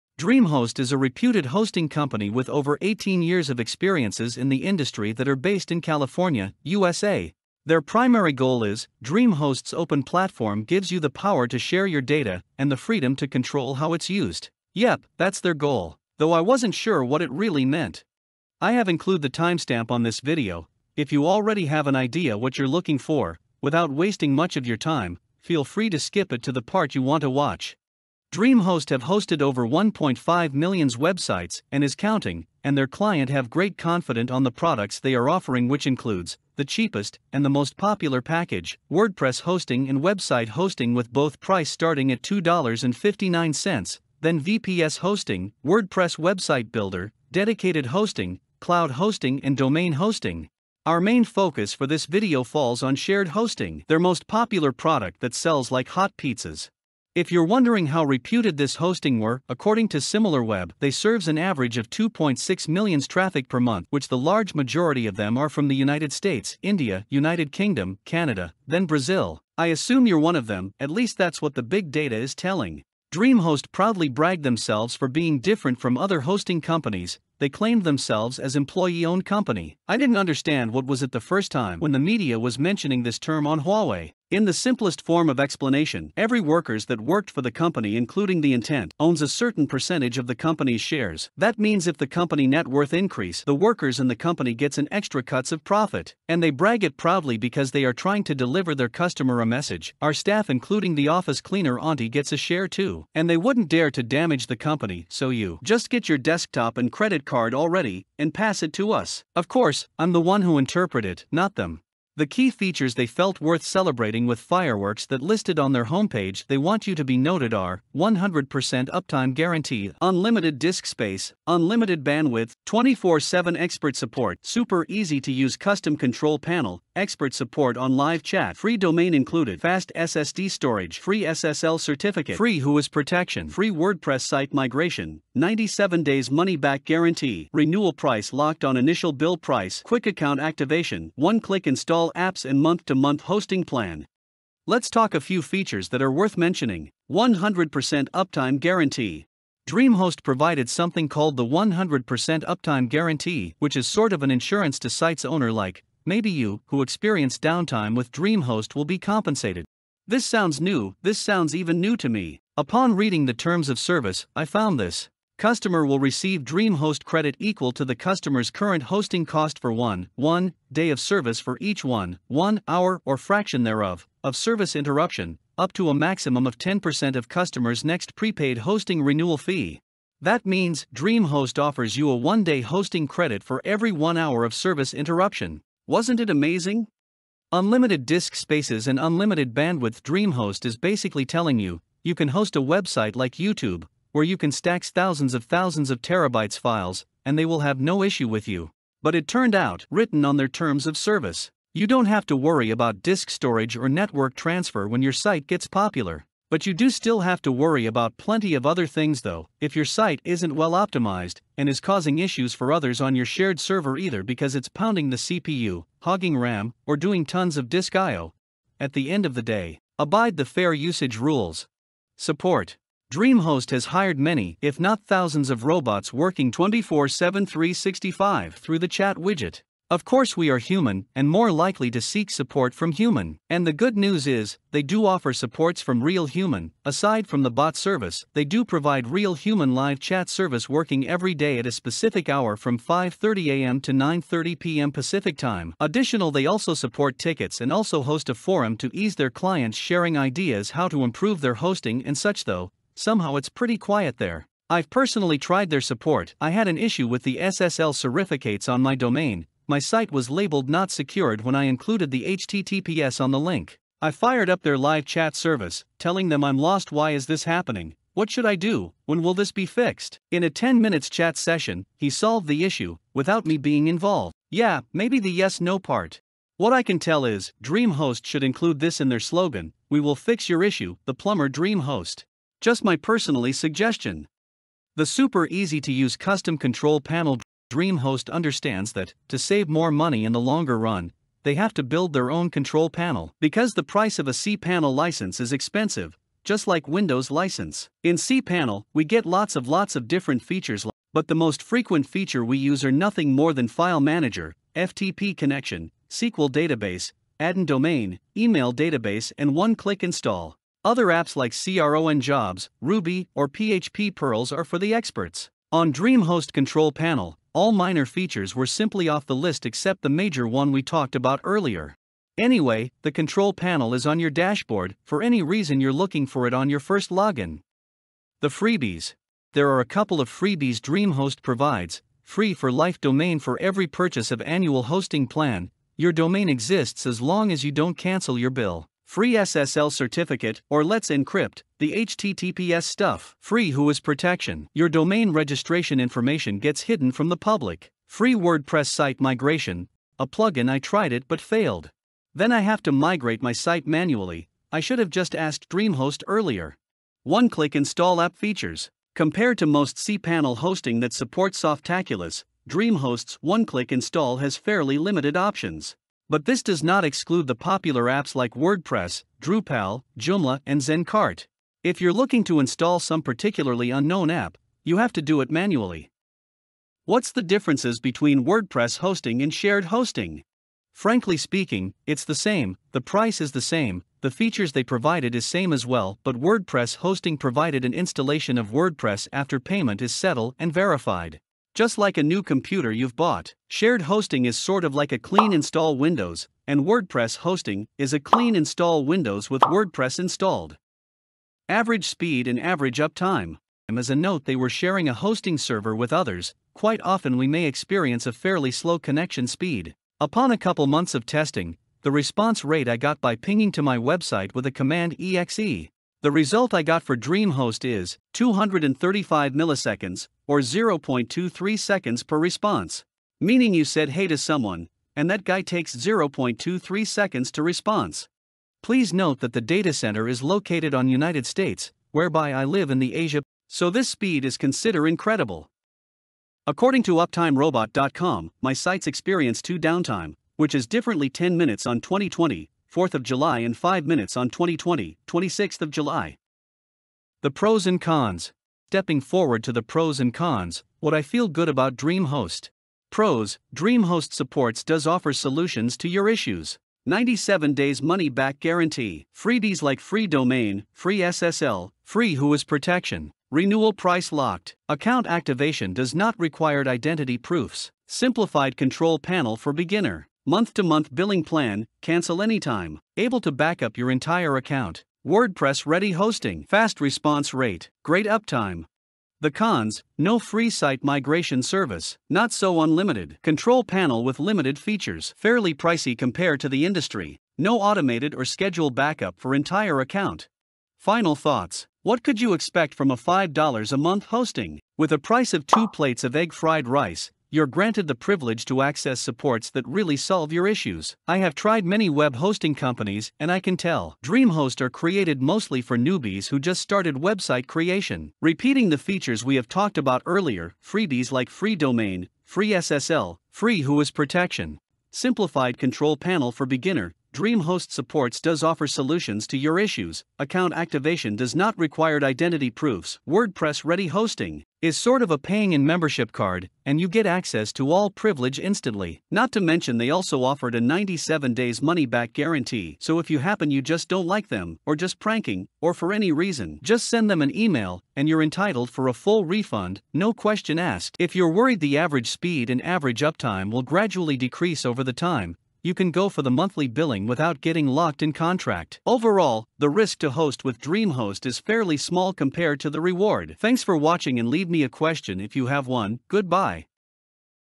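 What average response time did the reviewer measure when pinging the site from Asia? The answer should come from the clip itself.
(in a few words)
235 milliseconds.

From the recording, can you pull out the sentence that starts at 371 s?
If you're looking to install some particularly unknown app, you have to do it manually.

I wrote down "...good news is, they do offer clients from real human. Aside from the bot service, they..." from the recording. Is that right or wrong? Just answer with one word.
wrong.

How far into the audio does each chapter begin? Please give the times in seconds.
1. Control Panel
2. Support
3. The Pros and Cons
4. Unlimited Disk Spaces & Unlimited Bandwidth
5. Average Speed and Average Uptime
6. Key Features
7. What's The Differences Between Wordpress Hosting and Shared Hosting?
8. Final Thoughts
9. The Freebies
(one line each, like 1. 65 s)
1. 284 s
2. 222 s
3. 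445 s
4. 187 s
5. 401 s
6. 112 s
7. 377 s
8. 491 s
9. 328 s.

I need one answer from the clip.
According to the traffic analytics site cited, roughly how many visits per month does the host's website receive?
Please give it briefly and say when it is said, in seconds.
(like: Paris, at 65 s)
2.6 million, at 61 s.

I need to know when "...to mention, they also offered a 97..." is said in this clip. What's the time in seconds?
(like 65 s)
529 s.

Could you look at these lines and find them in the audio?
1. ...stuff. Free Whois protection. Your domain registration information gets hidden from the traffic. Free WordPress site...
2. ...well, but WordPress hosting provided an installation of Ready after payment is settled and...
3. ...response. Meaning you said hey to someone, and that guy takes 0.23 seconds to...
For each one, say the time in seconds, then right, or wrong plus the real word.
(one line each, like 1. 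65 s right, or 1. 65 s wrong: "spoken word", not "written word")
1. 342 s wrong: "public", not "traffic"
2. 385 s wrong: "WordPress", not "Ready"
3. 422 s right.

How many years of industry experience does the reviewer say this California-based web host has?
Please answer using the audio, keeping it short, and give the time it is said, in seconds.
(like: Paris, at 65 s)
18, at 2 s.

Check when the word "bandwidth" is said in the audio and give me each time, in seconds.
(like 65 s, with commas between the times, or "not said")
122 s, 189 s.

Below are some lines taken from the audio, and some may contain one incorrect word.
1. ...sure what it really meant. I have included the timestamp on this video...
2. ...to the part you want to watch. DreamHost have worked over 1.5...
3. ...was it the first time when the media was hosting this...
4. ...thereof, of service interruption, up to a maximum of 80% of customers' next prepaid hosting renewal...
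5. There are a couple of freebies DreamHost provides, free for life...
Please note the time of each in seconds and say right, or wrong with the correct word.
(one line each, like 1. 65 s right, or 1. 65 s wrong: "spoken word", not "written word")
1. 16 s right
2. 26 s wrong: "hosted", not "worked"
3. 80 s wrong: "mentioning", not "hosting"
4. 173 s wrong: "10", not "80"
5. 329 s right.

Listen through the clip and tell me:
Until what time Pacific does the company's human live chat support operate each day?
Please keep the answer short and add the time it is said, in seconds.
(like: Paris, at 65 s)
9:30 p.m., at 243 s.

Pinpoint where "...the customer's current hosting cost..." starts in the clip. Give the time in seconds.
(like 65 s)
167 s.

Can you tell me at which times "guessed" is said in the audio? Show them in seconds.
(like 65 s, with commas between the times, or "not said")
not said.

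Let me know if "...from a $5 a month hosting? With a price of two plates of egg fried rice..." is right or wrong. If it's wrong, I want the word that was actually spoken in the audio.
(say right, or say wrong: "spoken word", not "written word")
right.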